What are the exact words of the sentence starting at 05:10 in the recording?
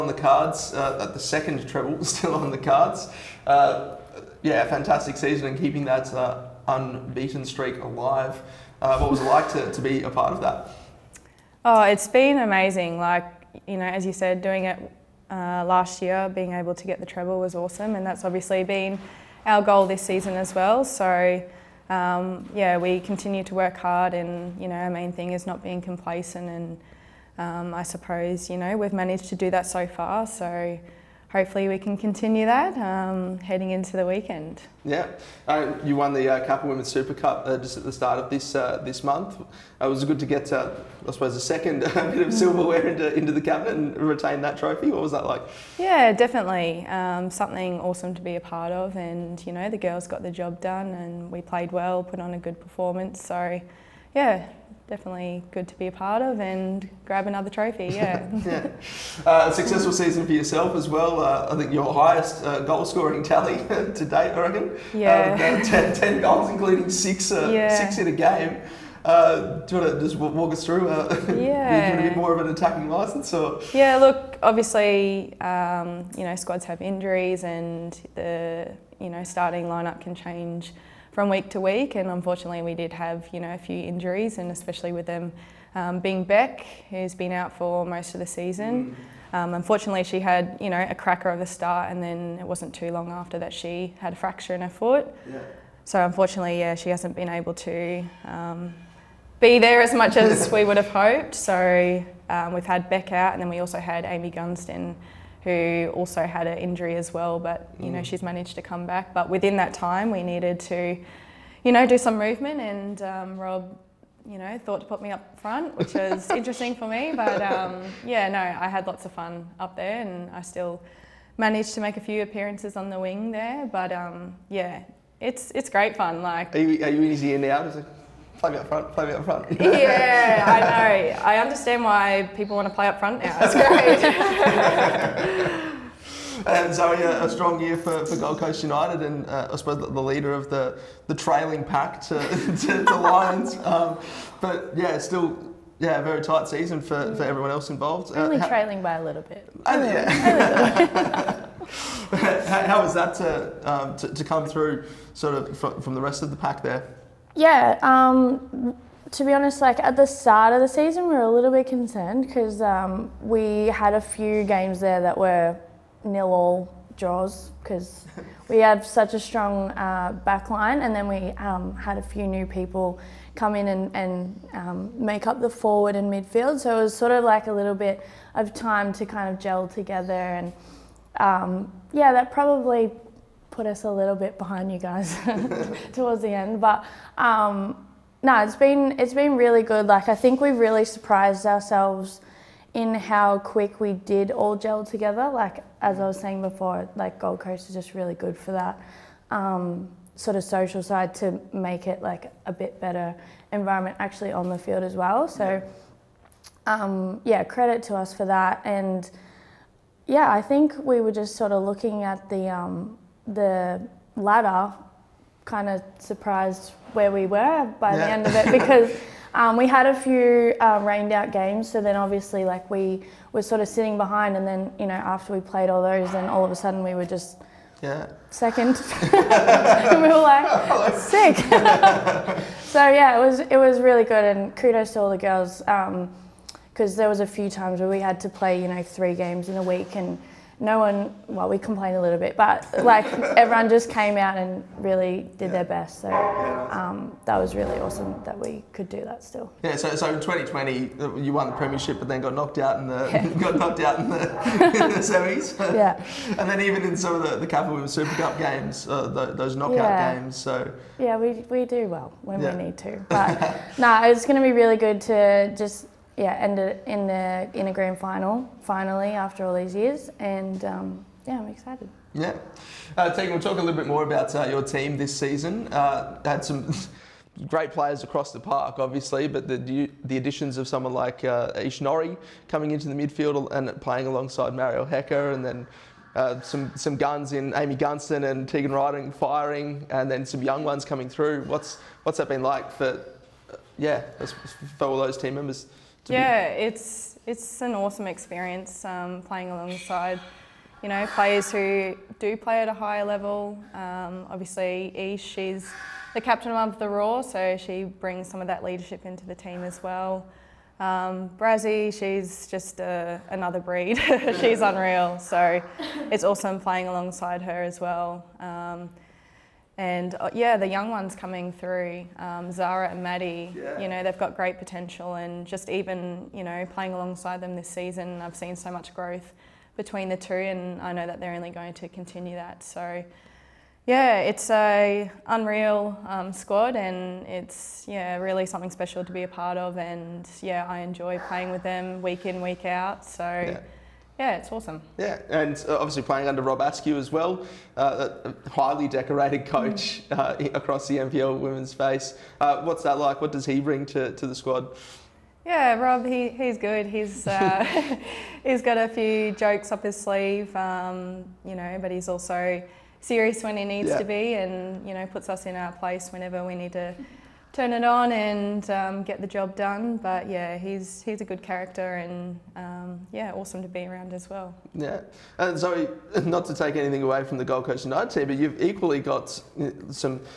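Um, Brazzy, she's just uh, another breed.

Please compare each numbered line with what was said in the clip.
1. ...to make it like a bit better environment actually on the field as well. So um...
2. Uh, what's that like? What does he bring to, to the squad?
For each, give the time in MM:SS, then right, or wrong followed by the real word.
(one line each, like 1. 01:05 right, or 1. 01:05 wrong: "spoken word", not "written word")
1. 03:21 right
2. 05:52 right.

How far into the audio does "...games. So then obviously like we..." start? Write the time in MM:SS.
03:41.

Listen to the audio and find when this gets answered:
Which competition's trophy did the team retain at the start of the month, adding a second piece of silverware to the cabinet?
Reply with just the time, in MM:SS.
00:36.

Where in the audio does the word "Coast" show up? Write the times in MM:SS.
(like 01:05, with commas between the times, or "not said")
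02:18, 03:17, 06:17.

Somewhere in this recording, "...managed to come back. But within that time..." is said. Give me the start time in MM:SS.
01:48.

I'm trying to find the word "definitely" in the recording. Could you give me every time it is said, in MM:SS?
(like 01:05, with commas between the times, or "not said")
00:46, 00:54.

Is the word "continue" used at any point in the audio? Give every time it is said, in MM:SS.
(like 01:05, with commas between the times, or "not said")
00:22, 00:31, 05:31.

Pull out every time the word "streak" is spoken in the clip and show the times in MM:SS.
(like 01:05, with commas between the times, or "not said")
00:07.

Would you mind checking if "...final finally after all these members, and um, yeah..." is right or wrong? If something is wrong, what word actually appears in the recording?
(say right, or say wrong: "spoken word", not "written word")
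wrong: "years", not "members".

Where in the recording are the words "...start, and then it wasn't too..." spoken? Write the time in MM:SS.
01:31.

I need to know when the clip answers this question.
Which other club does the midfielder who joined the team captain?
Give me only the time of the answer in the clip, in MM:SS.
05:06.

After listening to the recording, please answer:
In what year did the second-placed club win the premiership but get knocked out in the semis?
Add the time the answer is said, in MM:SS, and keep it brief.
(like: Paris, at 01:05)
2020, at 04:10.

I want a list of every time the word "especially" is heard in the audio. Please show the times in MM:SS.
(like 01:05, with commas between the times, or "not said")
01:24.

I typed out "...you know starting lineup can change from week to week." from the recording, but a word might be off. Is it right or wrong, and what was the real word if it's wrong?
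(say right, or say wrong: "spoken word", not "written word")
right.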